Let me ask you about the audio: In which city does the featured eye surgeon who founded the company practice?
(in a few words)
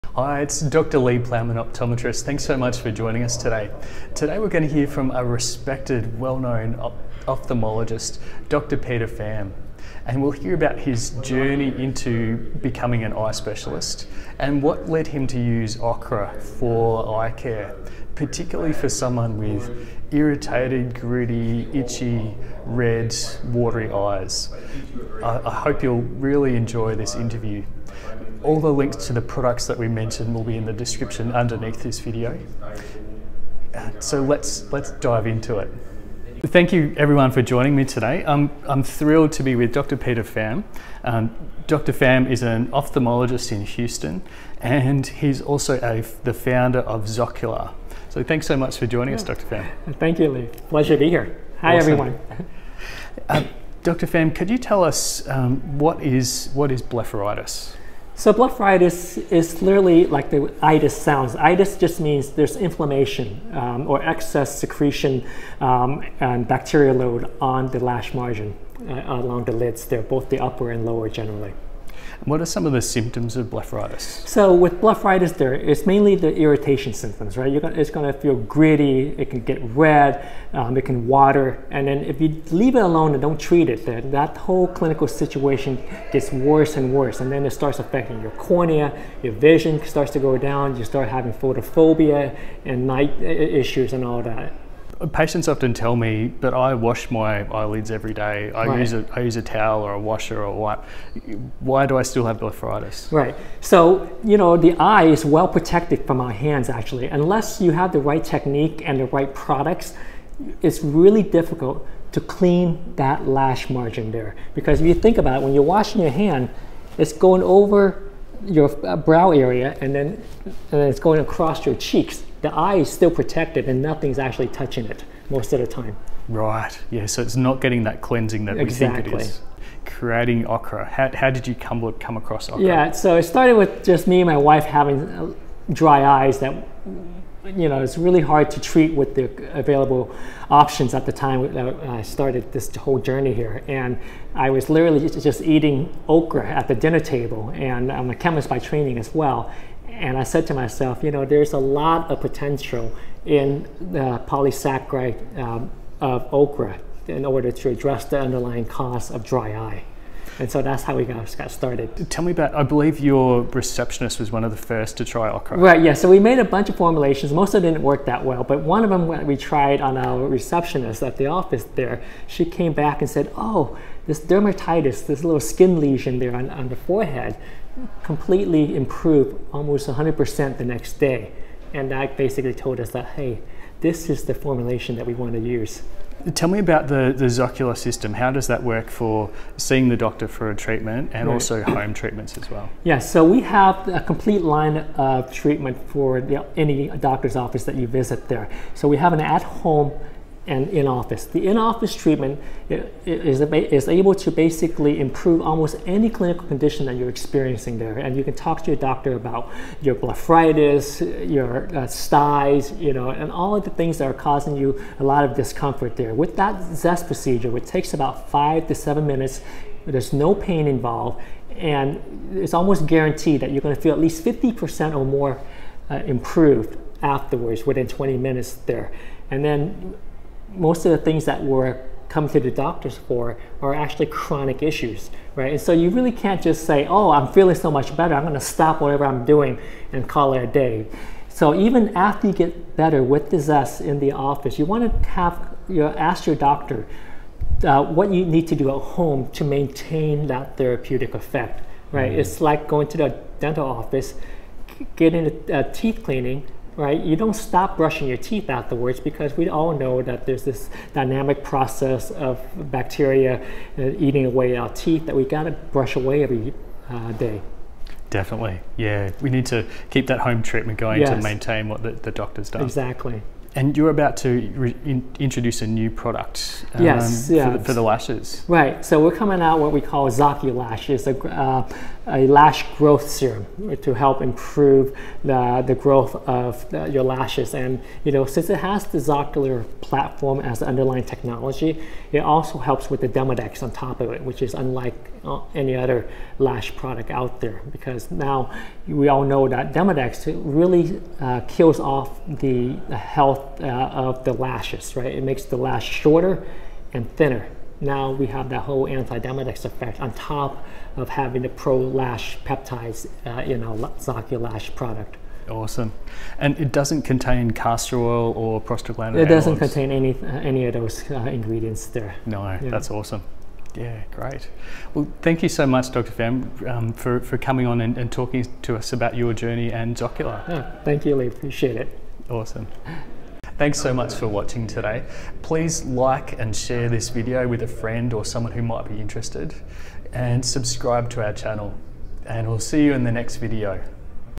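Houston.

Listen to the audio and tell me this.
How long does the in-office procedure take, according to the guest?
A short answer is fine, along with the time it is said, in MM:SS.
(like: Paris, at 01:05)
5 to 7 minutes, at 03:38.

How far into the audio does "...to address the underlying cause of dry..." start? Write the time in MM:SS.
02:37.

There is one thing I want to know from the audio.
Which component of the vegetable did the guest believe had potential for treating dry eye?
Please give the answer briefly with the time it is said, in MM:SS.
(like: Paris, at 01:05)
Polysaccharide, at 02:34.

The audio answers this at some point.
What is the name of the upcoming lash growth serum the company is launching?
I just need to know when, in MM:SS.
04:40.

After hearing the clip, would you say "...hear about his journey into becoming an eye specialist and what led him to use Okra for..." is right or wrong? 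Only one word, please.
right.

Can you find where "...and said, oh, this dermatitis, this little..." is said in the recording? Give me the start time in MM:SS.
02:53.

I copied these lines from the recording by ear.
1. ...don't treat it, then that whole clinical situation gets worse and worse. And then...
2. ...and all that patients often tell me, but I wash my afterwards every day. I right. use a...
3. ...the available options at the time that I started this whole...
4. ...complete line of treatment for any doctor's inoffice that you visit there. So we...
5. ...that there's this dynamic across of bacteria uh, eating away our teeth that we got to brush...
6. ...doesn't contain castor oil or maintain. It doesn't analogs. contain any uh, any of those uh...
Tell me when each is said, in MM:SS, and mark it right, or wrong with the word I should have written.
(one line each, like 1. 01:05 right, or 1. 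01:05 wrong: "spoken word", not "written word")
1. 01:23 right
2. 01:33 wrong: "eyelids", not "afterwards"
3. 02:19 right
4. 03:14 wrong: "office", not "inoffice"
5. 04:20 wrong: "process", not "across"
6. 05:16 wrong: "prostaglandin", not "maintain".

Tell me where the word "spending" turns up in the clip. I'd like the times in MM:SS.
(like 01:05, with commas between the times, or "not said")
not said.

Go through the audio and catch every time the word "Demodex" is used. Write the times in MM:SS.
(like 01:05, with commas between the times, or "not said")
04:53, 04:59, 05:08.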